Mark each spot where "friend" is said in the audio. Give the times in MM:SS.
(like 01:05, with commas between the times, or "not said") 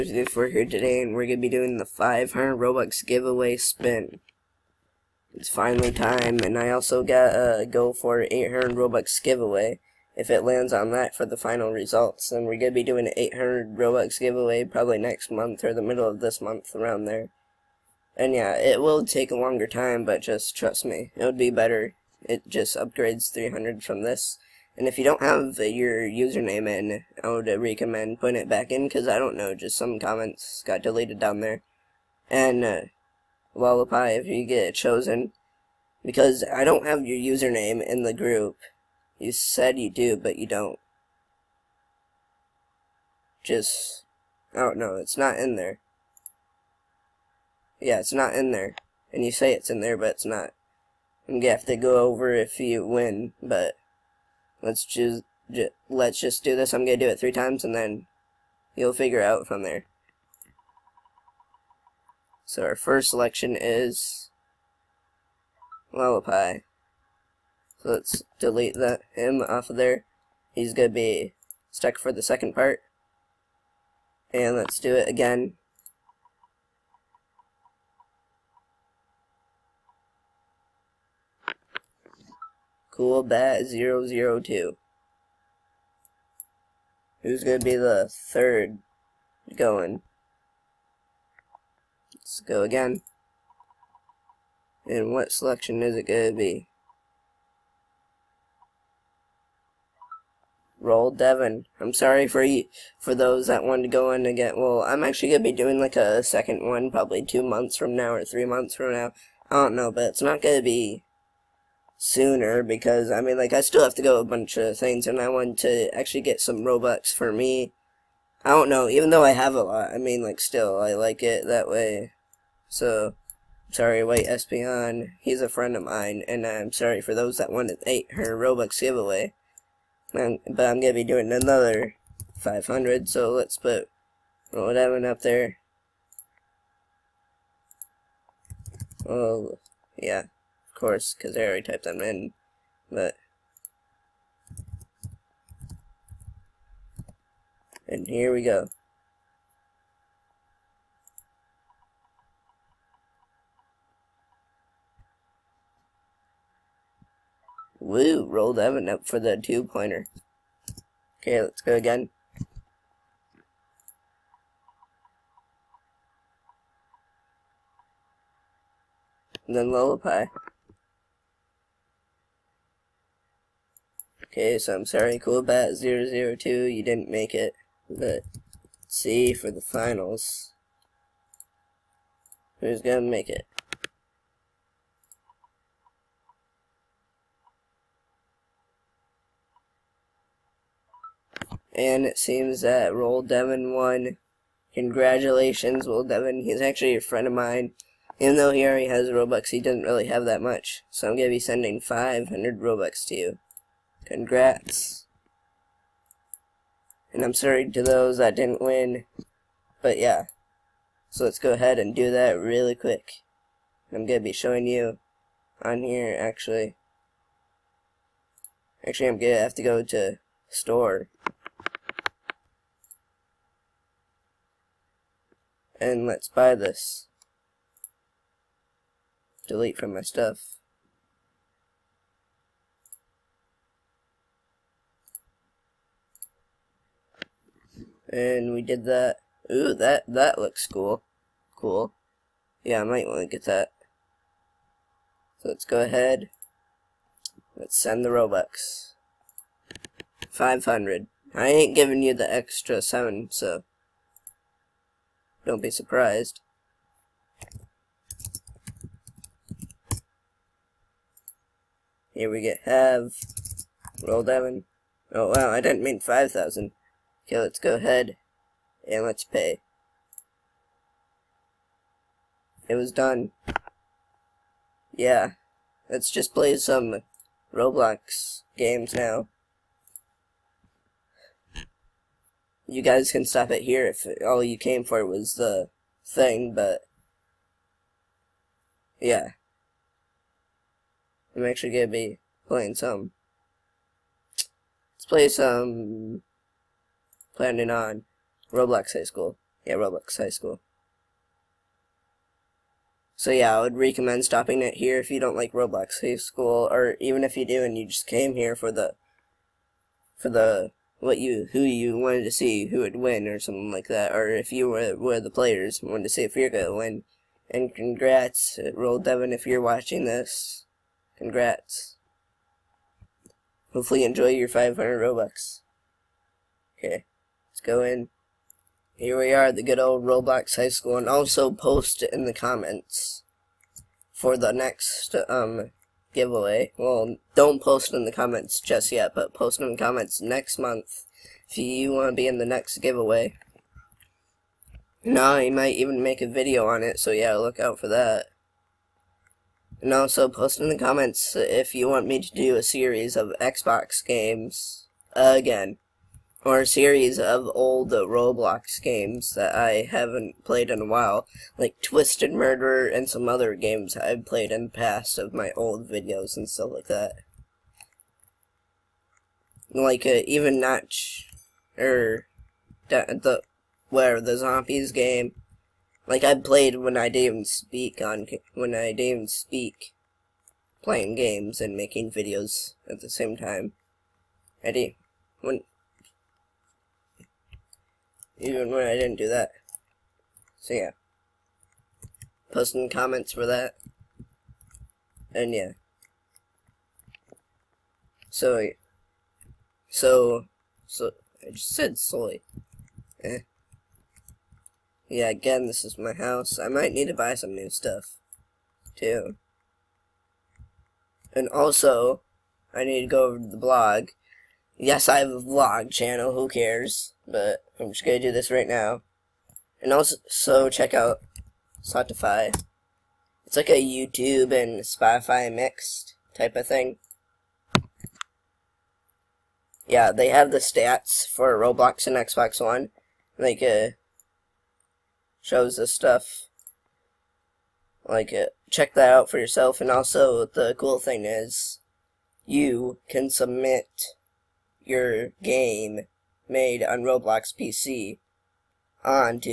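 02:05, 03:17.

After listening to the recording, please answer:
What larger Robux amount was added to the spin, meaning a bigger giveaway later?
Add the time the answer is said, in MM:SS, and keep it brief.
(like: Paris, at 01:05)
800, at 00:07.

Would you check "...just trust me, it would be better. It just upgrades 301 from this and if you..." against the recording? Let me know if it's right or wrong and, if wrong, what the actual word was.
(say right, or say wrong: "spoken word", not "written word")
wrong: "300", not "301".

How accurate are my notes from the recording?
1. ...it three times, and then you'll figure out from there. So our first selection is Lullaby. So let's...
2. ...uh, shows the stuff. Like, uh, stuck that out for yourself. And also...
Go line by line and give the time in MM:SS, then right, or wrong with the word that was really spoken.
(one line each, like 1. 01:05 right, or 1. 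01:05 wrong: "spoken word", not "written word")
1. 00:57 right
2. 07:13 wrong: "check", not "stuck".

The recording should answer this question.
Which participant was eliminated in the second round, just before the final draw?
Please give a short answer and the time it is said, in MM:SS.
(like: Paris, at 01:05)
CoolBat002, at 02:55.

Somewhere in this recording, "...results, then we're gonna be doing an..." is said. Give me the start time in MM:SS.
00:11.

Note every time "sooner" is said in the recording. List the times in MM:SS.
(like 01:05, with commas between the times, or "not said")
01:52.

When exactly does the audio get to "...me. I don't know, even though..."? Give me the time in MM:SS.
01:57.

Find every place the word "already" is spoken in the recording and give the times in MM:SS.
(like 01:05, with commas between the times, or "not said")
02:21, 03:18.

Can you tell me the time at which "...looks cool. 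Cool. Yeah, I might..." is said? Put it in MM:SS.
04:00.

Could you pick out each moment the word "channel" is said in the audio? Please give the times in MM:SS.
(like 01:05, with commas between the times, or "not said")
06:55.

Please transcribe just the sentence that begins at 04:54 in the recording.
Let's play some Planning on Roblox High School.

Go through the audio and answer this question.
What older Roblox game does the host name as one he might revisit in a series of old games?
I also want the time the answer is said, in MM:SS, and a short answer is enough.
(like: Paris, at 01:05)
Twisted Murderer, at 06:01.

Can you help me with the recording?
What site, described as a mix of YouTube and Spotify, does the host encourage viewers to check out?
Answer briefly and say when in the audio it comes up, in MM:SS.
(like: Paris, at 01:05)
Syotify, at 07:01.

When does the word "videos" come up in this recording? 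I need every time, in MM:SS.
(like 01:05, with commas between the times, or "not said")
05:46, 06:05, 06:22.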